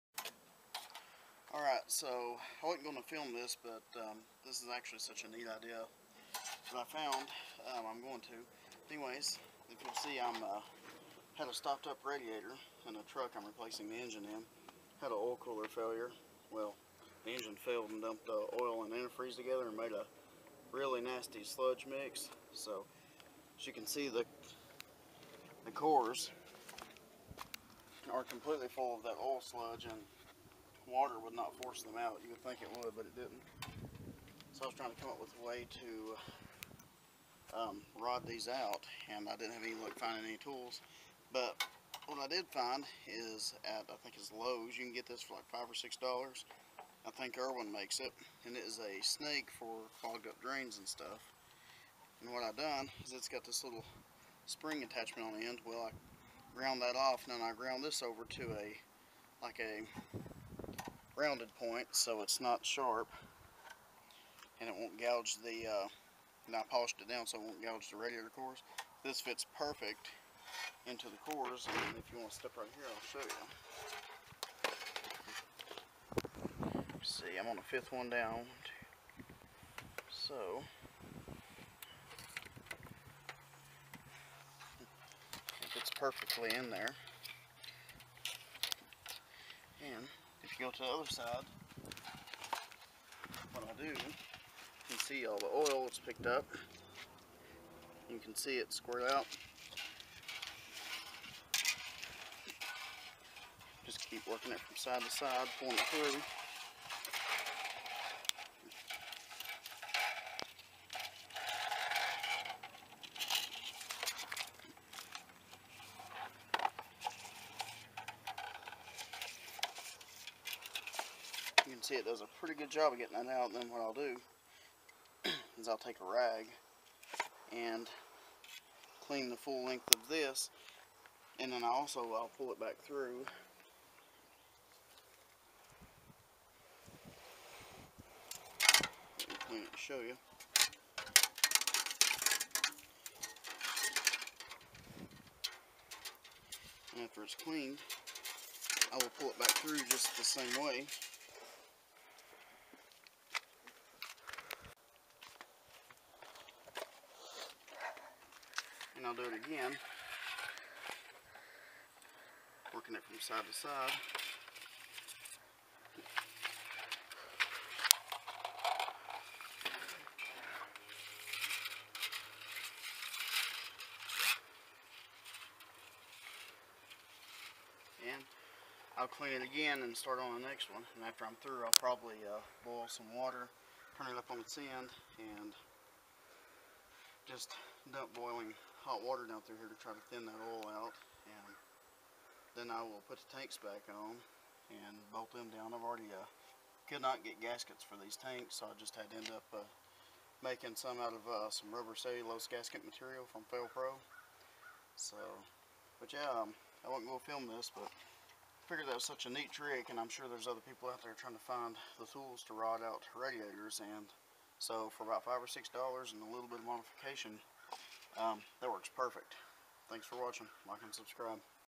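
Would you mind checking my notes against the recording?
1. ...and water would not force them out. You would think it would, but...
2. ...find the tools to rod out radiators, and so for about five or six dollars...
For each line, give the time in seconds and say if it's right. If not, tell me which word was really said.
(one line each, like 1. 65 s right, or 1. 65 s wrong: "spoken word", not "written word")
1. 29 s right
2. 211 s right.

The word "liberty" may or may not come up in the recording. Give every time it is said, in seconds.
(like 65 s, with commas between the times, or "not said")
not said.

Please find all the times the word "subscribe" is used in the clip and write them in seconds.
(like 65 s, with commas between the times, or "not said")
220 s.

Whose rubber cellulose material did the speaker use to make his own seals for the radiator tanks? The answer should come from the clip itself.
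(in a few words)
Fel-Pro.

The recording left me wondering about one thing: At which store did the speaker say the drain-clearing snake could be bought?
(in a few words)
Lowe's.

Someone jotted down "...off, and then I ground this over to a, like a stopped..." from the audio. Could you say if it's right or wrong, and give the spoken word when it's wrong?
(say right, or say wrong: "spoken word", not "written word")
wrong: "rounded", not "stopped".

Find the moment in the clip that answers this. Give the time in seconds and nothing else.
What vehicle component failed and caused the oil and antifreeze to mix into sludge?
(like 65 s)
15 s.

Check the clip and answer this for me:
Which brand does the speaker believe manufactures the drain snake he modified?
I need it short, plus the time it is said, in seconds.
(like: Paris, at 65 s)
Irwin, at 47 s.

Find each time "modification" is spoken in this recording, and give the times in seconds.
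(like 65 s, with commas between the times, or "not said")
216 s.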